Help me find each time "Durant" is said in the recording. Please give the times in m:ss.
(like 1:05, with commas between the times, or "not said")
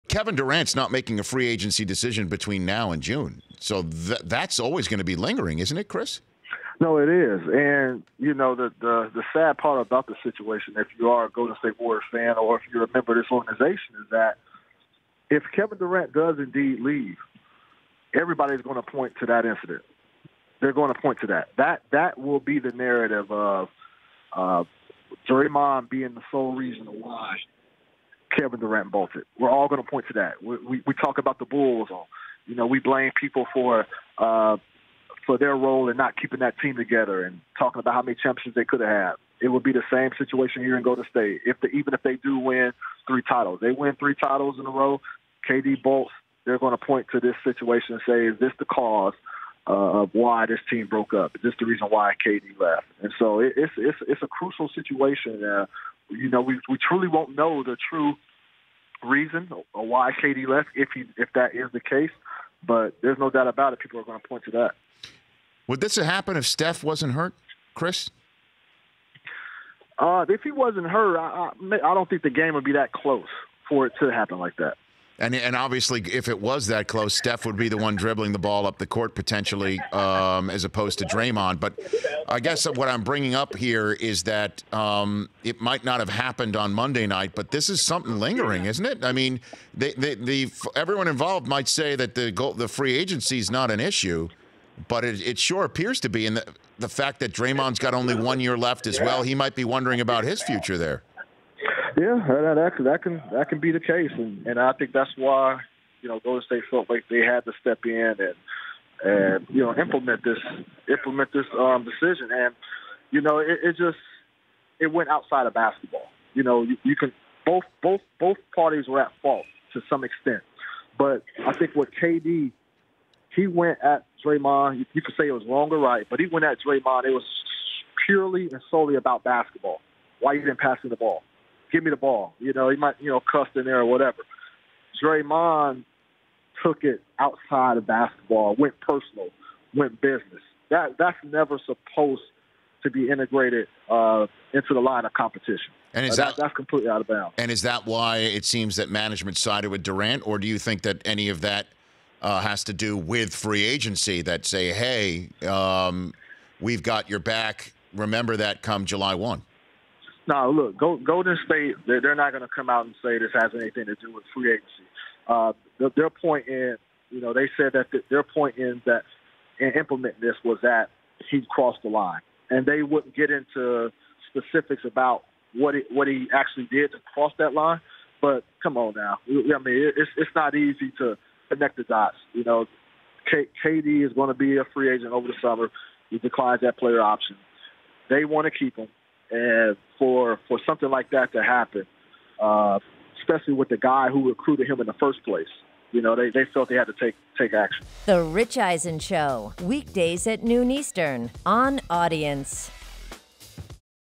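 0:00, 0:15, 0:28, 2:29.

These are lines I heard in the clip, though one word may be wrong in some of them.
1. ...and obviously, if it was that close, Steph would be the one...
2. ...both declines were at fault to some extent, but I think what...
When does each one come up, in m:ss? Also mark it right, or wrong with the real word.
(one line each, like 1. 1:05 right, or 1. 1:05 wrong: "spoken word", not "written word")
1. 1:15 right
2. 1:58 wrong: "parties", not "declines".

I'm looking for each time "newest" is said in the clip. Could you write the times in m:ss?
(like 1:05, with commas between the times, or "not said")
not said.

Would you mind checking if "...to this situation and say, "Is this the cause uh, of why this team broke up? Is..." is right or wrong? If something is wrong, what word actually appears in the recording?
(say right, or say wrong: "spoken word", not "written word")
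right.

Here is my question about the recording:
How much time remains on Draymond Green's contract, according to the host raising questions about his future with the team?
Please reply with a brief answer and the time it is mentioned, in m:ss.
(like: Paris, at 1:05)
1 year, at 1:38.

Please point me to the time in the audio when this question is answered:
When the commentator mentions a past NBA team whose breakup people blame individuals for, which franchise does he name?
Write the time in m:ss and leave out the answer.
0:31.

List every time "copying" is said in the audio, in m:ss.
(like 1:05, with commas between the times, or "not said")
not said.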